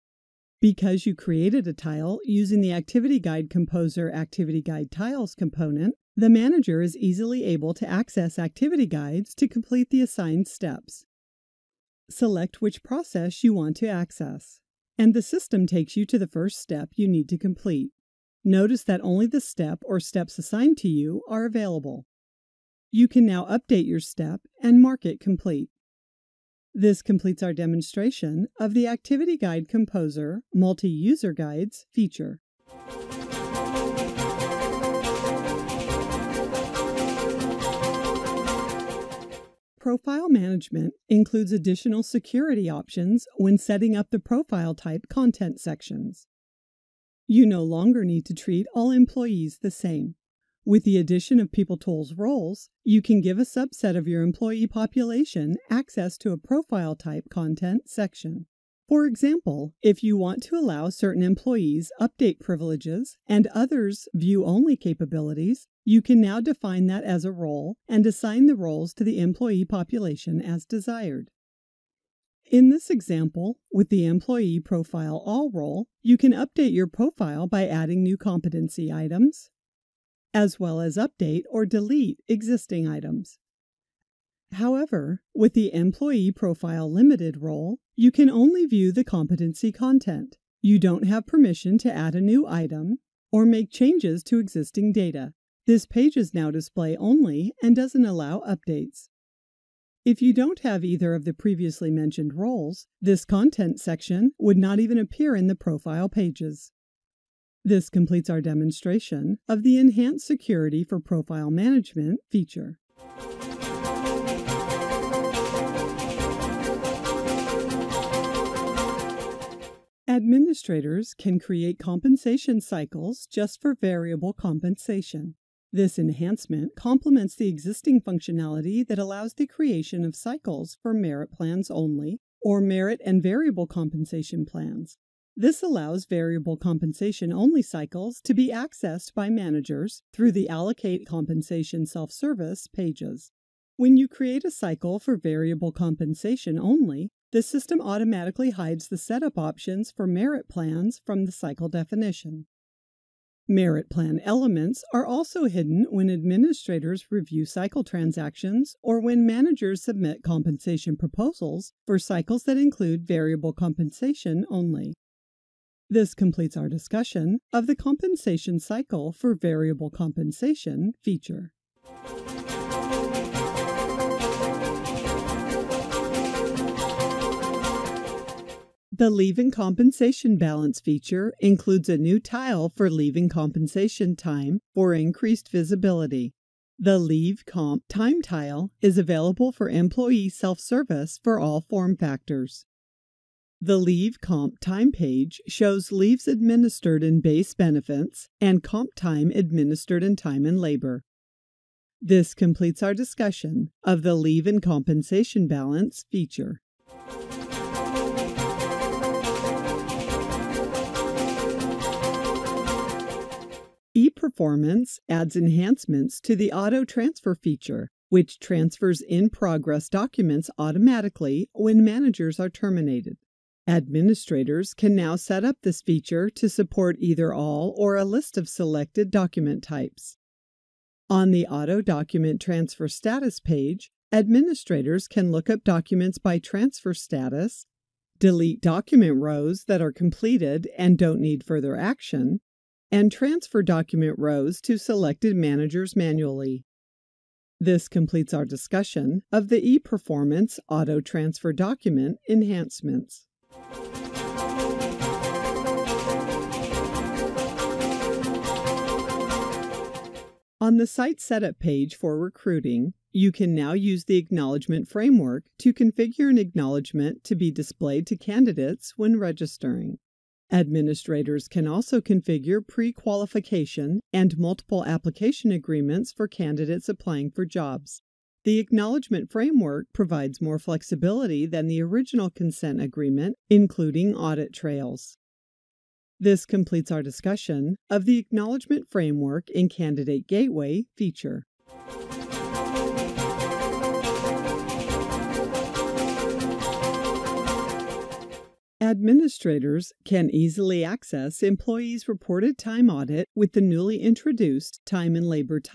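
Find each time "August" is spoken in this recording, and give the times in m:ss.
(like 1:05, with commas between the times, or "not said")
not said.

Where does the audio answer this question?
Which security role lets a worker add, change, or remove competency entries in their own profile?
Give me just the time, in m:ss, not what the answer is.
1:14.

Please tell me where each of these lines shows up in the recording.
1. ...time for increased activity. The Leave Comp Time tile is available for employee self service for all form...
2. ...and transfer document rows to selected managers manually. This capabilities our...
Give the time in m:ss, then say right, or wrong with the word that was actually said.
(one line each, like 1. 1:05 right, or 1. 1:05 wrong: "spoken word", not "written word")
1. 3:04 wrong: "visibility", not "activity"
2. 4:02 wrong: "completes", not "capabilities".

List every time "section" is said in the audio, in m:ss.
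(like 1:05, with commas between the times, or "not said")
0:45, 0:57, 1:43.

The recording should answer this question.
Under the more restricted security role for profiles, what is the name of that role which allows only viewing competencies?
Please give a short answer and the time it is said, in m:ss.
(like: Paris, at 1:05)
Employee Profile Limited, at 1:25.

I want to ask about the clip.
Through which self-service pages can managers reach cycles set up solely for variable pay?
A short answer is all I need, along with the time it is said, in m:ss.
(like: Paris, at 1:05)
Allocate Compensation, at 2:20.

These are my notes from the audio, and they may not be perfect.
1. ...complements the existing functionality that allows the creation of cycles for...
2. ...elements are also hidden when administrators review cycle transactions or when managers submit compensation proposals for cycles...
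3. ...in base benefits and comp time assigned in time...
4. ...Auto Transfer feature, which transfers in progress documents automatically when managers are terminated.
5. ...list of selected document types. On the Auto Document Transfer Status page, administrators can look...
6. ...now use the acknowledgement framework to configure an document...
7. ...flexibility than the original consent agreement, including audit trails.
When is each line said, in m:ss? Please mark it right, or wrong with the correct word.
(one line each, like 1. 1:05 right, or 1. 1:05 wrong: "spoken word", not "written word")
1. 2:06 right
2. 2:34 right
3. 3:17 wrong: "administered", not "assigned"
4. 3:36 right
5. 3:48 right
6. 4:23 wrong: "acknowledgement", not "document"
7. 4:40 right.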